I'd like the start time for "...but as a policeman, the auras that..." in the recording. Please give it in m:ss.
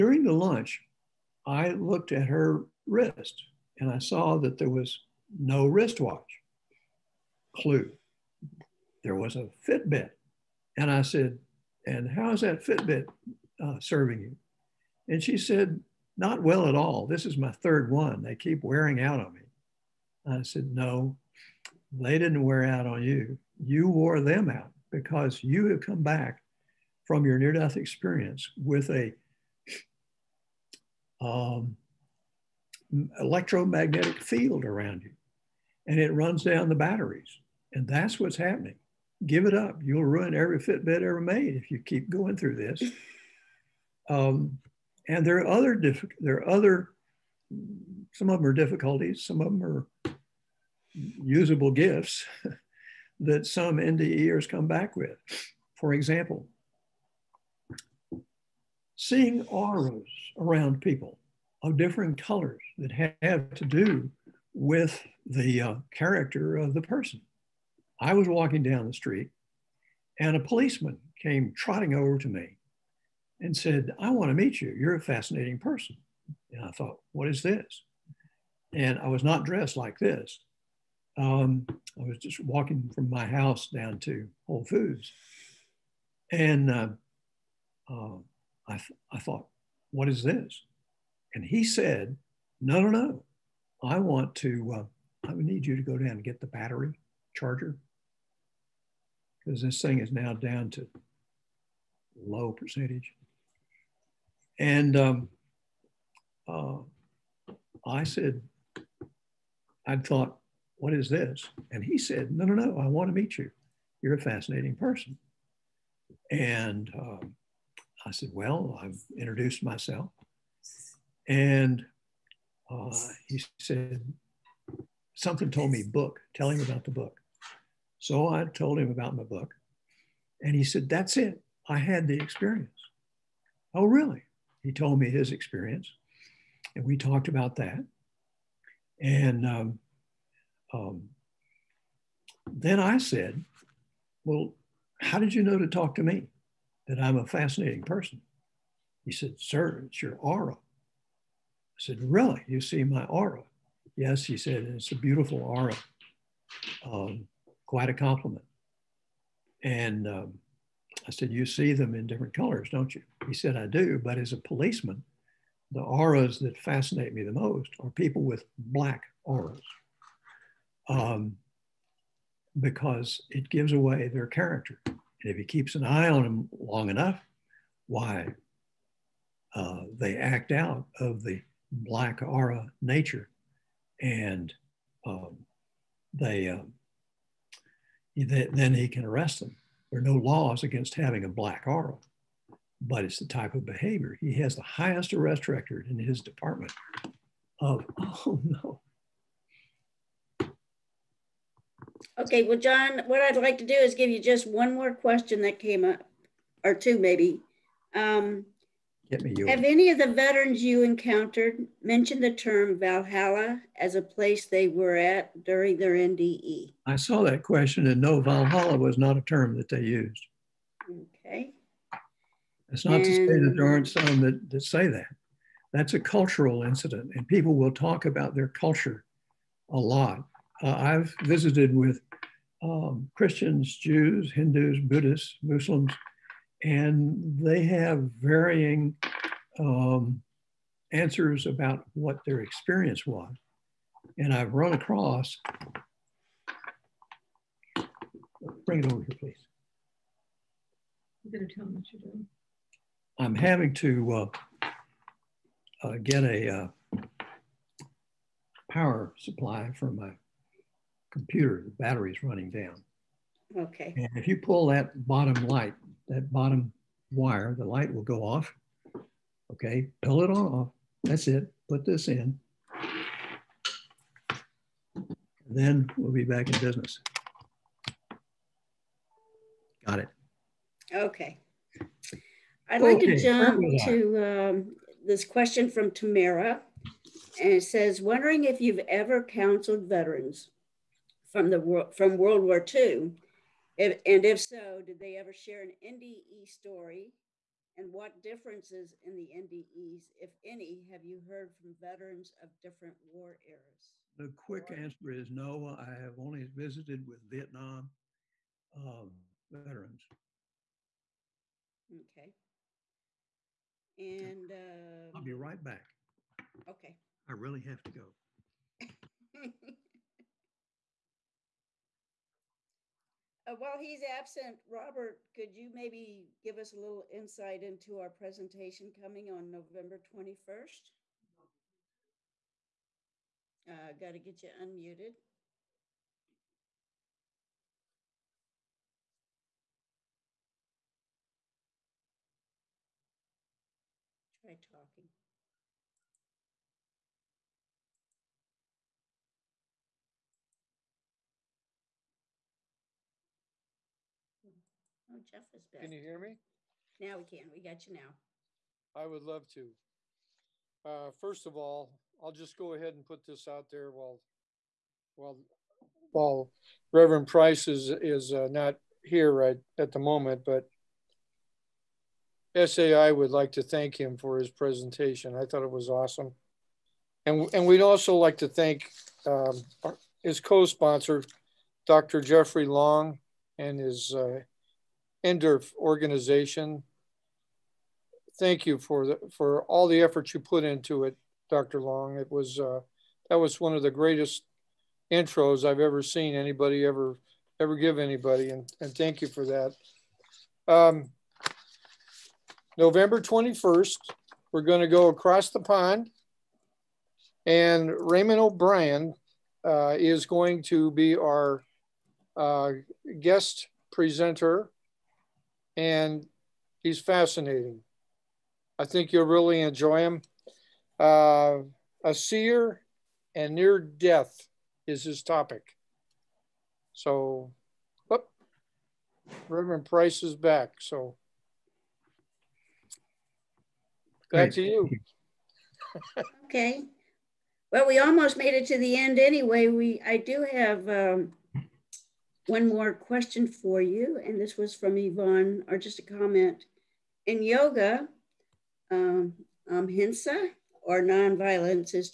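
2:43.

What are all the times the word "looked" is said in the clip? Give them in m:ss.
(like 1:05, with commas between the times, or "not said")
0:01.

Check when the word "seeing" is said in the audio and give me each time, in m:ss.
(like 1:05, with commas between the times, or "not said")
0:58.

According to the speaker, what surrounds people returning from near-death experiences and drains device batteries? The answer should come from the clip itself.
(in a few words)
electromagnetic field.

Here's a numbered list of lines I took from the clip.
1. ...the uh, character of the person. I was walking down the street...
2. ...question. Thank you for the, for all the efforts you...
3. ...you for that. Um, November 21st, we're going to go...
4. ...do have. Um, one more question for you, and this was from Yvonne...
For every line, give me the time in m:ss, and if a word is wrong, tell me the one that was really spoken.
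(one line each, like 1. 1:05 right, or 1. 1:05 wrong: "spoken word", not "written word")
1. 1:05 right
2. 6:25 wrong: "organization", not "question"
3. 6:39 right
4. 7:20 right.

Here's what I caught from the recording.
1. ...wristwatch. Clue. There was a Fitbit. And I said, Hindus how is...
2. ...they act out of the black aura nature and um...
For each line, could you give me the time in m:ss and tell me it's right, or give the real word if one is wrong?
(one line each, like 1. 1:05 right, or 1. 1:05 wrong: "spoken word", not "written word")
1. 0:05 wrong: "And", not "Hindus"
2. 2:59 right.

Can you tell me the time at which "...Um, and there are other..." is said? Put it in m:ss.
0:44.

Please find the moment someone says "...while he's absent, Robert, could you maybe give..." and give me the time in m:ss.
5:23.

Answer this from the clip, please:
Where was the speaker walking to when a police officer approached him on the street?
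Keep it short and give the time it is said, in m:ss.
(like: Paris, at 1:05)
Whole Foods, at 1:24.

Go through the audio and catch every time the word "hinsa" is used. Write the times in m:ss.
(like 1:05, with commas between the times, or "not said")
7:29.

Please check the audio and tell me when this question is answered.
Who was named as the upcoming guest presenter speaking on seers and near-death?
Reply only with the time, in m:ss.
6:47.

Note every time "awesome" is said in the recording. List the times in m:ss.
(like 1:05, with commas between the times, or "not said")
6:15.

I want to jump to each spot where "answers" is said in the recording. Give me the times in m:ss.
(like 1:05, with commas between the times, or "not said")
4:00, 5:04.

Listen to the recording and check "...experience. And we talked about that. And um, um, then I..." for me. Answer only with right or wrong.
right.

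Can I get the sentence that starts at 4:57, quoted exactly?
And what differences in the NDEs, if any, have you heard from veterans of different war eras?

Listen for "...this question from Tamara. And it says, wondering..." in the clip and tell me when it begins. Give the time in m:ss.
4:45.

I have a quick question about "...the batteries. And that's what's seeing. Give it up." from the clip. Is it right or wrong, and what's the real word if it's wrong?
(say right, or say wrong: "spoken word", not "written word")
wrong: "happening", not "seeing".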